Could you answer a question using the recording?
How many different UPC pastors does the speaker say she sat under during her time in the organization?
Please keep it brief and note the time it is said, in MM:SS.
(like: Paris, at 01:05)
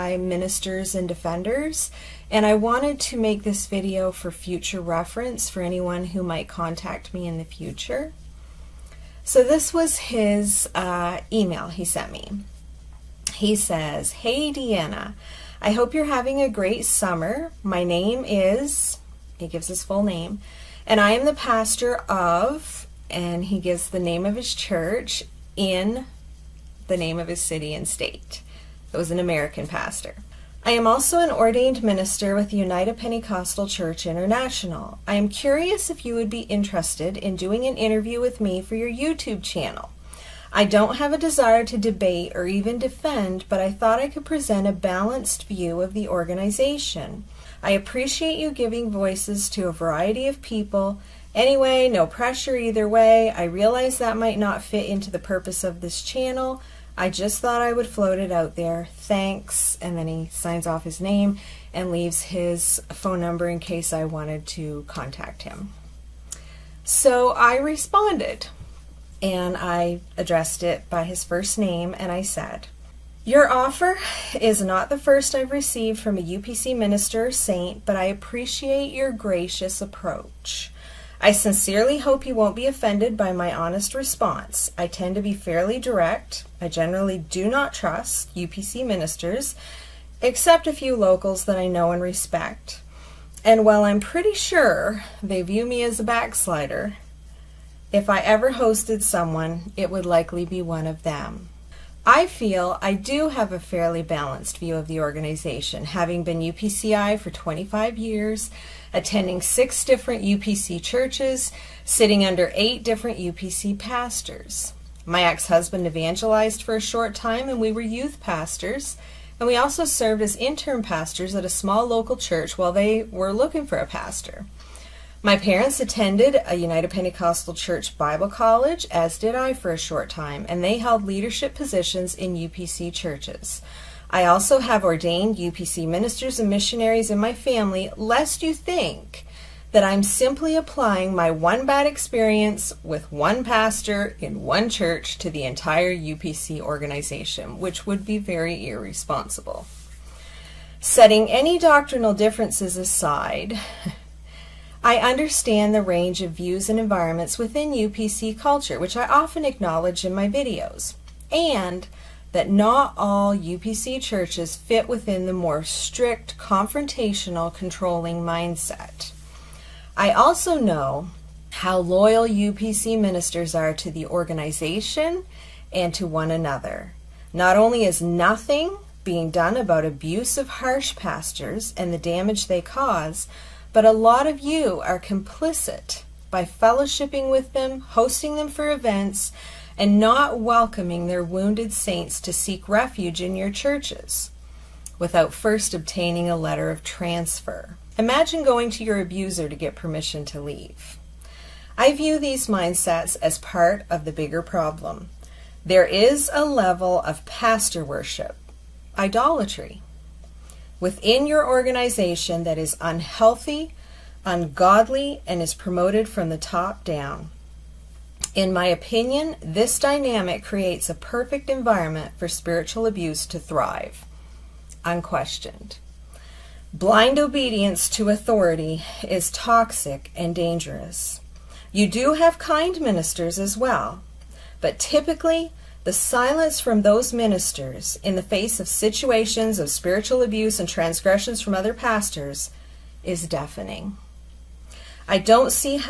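8, at 01:52.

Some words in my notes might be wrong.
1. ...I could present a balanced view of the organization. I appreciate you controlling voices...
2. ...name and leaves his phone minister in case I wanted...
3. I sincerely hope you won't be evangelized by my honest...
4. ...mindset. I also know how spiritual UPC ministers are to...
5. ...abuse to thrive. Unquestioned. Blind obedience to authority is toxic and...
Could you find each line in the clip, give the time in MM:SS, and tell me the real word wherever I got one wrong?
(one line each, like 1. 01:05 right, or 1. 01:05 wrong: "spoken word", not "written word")
1. 00:43 wrong: "giving", not "controlling"
2. 01:01 wrong: "number", not "minister"
3. 01:21 wrong: "offended", not "evangelized"
4. 02:48 wrong: "loyal", not "spiritual"
5. 03:42 right.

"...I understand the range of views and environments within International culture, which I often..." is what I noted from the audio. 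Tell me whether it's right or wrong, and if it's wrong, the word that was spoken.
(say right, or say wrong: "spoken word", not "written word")
wrong: "UPC", not "International".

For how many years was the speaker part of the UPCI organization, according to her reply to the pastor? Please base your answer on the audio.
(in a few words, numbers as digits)
25.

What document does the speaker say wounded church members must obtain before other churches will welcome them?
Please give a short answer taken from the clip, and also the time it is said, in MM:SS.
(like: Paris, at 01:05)
letter of transfer, at 03:16.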